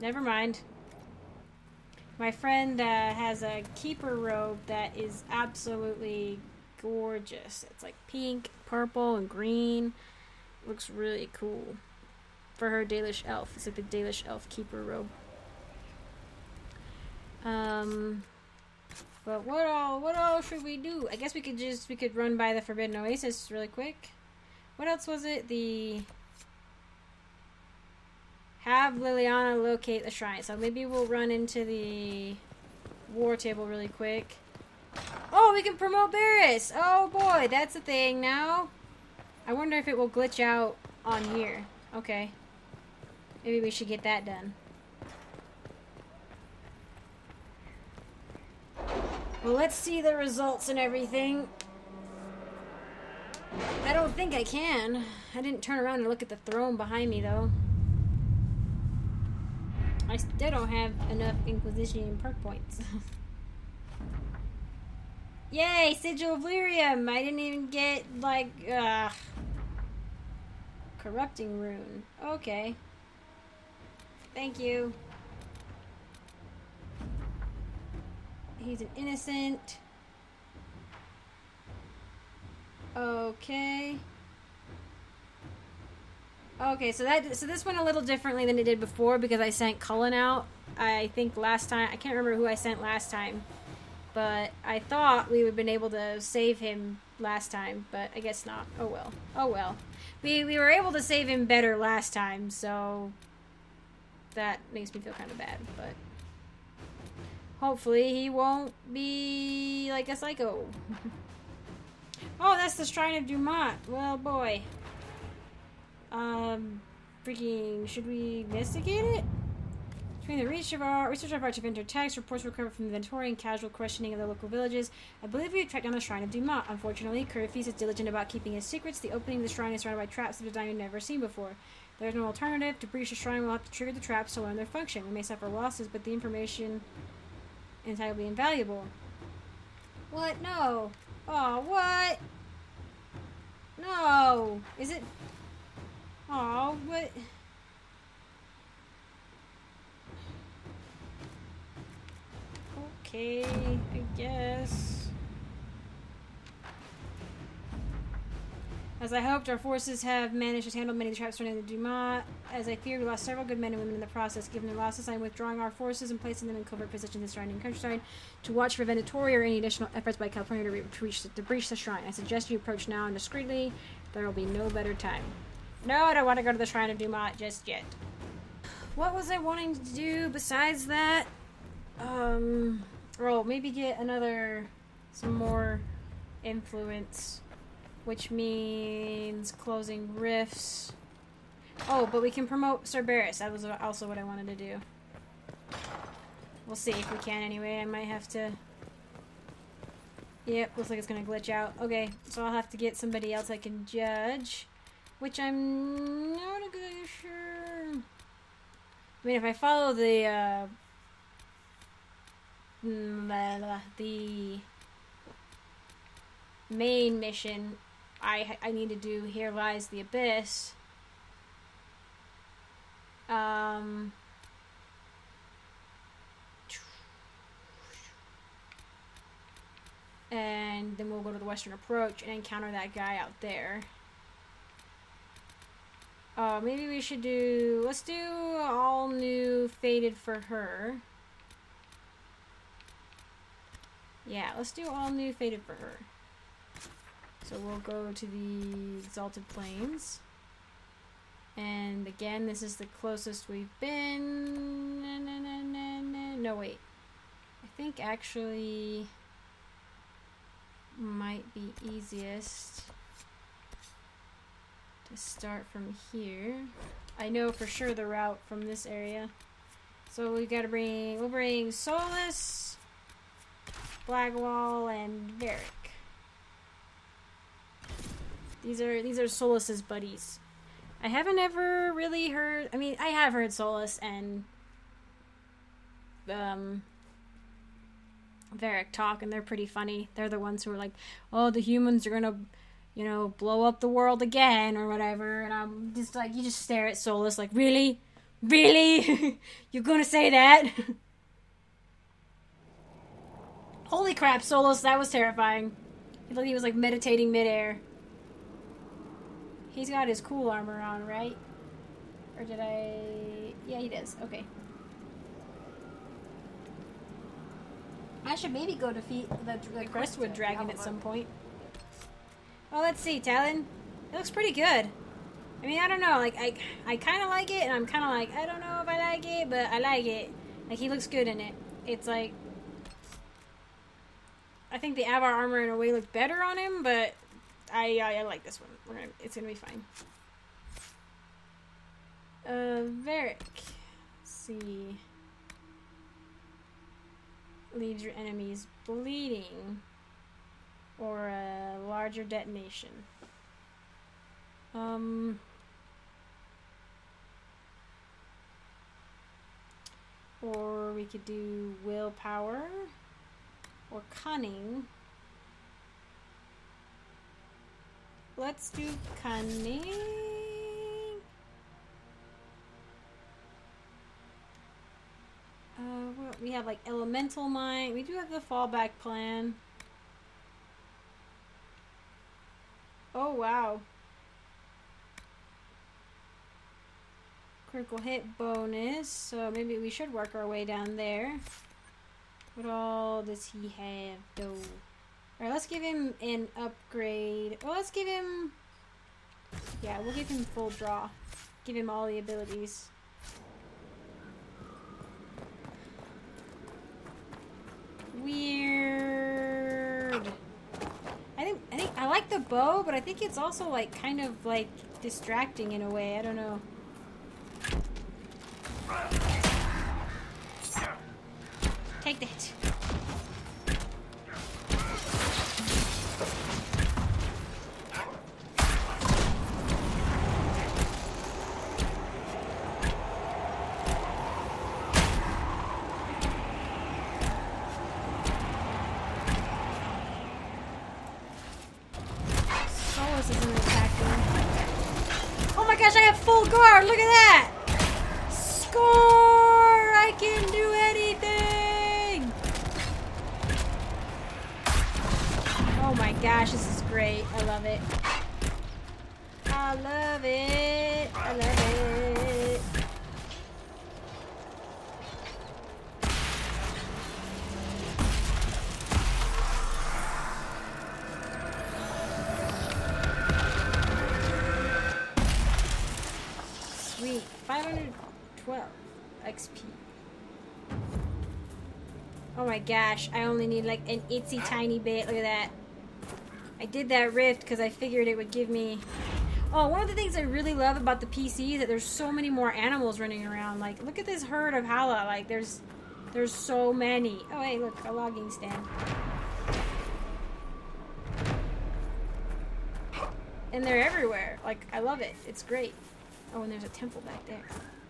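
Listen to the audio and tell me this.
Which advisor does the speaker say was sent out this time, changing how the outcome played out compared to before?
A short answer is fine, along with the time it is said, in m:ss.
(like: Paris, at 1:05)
Cullen, at 1:29.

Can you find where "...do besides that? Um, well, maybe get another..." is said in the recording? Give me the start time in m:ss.
2:59.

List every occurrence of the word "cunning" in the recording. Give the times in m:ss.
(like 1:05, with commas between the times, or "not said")
6:04, 6:09.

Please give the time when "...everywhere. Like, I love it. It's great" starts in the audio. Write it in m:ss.
8:23.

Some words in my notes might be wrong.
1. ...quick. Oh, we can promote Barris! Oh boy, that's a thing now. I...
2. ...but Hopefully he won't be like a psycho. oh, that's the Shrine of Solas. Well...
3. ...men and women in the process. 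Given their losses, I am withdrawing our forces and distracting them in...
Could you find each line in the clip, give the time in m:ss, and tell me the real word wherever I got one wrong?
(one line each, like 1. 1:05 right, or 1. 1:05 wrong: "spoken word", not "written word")
1. 0:33 right
2. 1:45 wrong: "Dumat", not "Solas"
3. 2:43 wrong: "placing", not "distracting".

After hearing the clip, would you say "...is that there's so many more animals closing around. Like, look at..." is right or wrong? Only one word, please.
wrong.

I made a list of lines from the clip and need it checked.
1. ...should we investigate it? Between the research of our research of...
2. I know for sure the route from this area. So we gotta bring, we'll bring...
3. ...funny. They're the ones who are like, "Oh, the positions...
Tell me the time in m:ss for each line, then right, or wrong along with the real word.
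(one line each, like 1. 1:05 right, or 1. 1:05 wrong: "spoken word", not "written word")
1. 1:57 right
2. 4:27 right
3. 4:49 wrong: "humans", not "positions".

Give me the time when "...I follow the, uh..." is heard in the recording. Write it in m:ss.
3:29.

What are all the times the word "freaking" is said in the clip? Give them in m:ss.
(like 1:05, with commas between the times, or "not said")
1:57.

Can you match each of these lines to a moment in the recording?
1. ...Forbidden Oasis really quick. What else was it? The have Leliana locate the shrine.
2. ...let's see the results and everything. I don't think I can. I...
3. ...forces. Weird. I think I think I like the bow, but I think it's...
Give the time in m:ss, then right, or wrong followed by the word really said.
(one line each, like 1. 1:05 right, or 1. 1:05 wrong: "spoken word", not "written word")
1. 0:22 right
2. 0:49 right
3. 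6:42 wrong: "abilities", not "forces".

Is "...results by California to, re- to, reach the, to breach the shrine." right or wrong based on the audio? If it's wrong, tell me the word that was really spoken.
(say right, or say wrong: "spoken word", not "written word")
wrong: "efforts", not "results".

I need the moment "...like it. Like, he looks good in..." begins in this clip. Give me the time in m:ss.
5:29.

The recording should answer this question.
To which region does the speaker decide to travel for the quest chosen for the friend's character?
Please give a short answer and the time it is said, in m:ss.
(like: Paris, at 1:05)
Exalted Plains, at 4:09.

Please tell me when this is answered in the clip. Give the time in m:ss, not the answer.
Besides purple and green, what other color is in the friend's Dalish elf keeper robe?
0:08.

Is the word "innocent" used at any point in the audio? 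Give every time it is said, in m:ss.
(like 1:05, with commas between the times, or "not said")
1:18.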